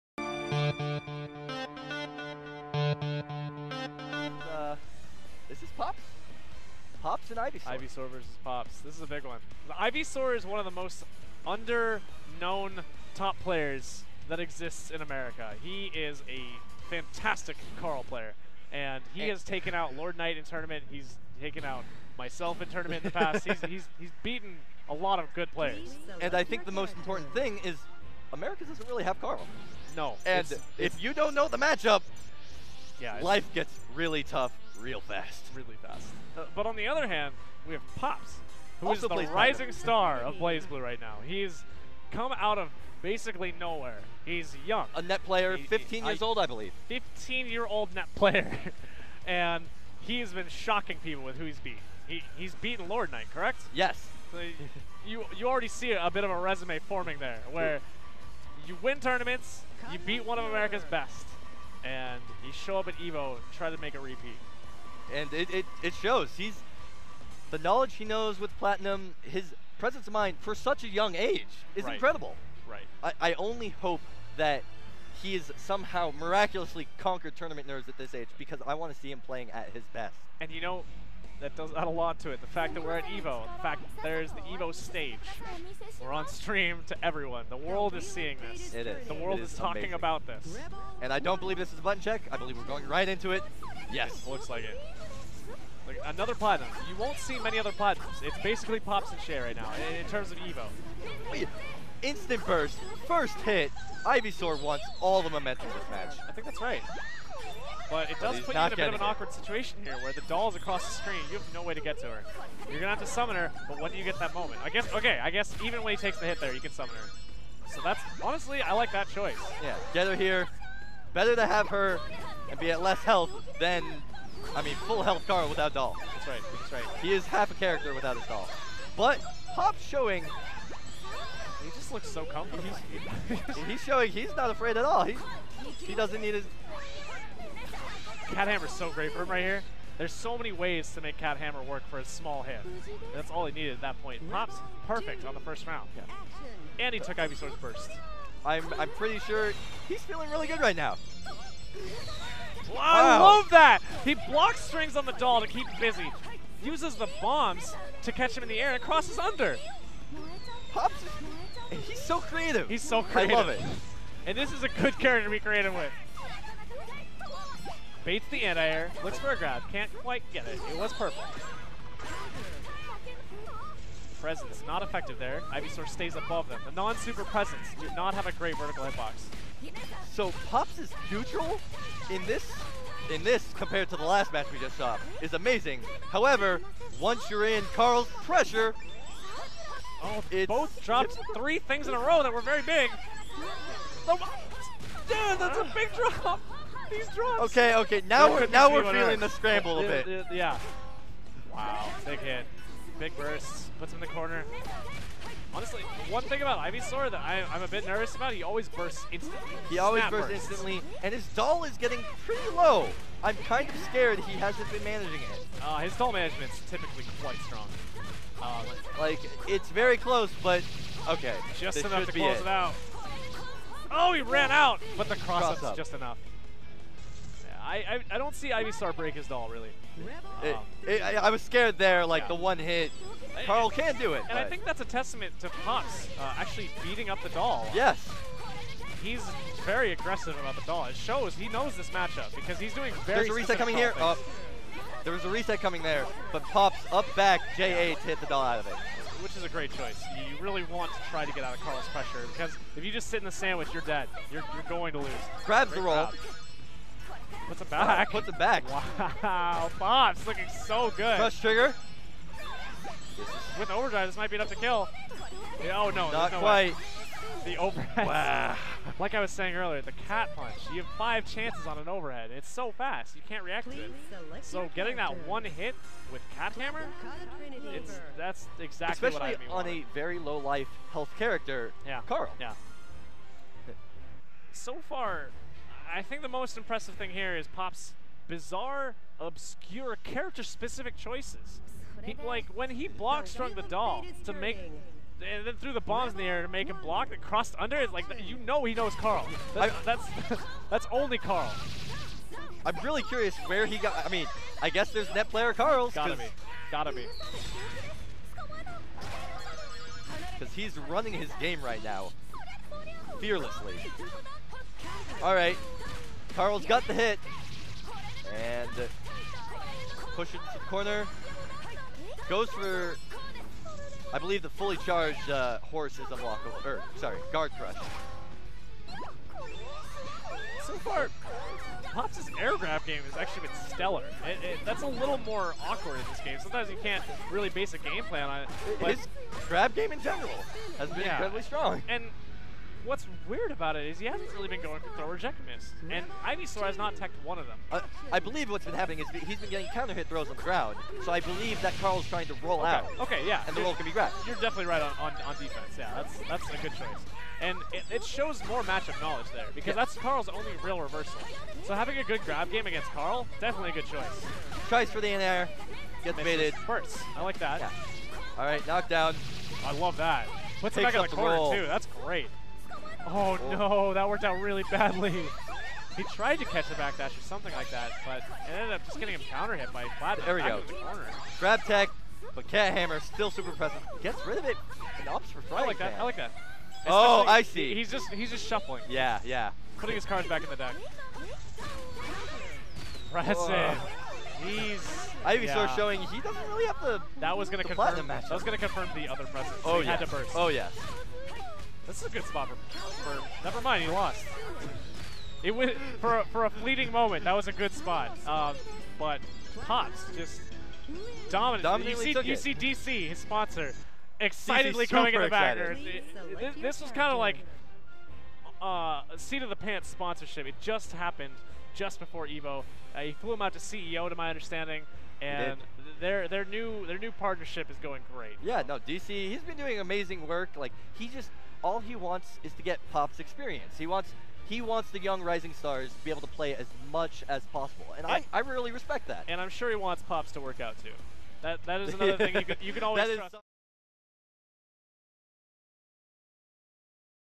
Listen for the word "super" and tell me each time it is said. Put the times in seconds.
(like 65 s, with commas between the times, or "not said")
176 s, 383 s.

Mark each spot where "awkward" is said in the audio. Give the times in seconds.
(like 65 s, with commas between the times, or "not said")
109 s, 335 s.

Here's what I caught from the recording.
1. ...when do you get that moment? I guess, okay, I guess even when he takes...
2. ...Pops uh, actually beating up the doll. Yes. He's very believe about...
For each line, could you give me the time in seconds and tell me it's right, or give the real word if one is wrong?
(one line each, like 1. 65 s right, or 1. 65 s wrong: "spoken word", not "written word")
1. 113 s right
2. 235 s wrong: "aggressive", not "believe".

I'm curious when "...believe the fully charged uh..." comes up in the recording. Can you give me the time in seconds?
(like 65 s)
324 s.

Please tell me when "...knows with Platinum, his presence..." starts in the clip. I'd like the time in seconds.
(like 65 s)
68 s.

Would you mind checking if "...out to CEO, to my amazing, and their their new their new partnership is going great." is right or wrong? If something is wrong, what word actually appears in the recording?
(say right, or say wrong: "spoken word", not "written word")
wrong: "understanding", not "amazing".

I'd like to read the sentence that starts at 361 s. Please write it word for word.
So having a good grab game against Carl, definitely a good choice.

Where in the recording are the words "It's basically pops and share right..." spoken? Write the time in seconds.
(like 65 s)
98 s.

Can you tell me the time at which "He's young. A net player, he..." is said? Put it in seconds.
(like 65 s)
44 s.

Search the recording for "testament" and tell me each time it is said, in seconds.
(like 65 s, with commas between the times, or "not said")
234 s.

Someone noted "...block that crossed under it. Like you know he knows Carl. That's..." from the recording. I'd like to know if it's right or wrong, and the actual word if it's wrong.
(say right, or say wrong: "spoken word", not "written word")
right.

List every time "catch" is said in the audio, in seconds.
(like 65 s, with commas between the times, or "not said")
158 s, 376 s.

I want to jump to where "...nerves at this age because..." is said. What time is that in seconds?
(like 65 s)
77 s.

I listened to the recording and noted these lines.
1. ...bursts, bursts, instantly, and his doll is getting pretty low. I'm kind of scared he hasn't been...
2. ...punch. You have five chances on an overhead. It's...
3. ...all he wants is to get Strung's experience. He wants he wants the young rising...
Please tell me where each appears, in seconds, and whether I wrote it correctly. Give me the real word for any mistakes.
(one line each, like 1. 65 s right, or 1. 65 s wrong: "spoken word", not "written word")
1. 210 s right
2. 270 s right
3. 431 s wrong: "Pop", not "Strung".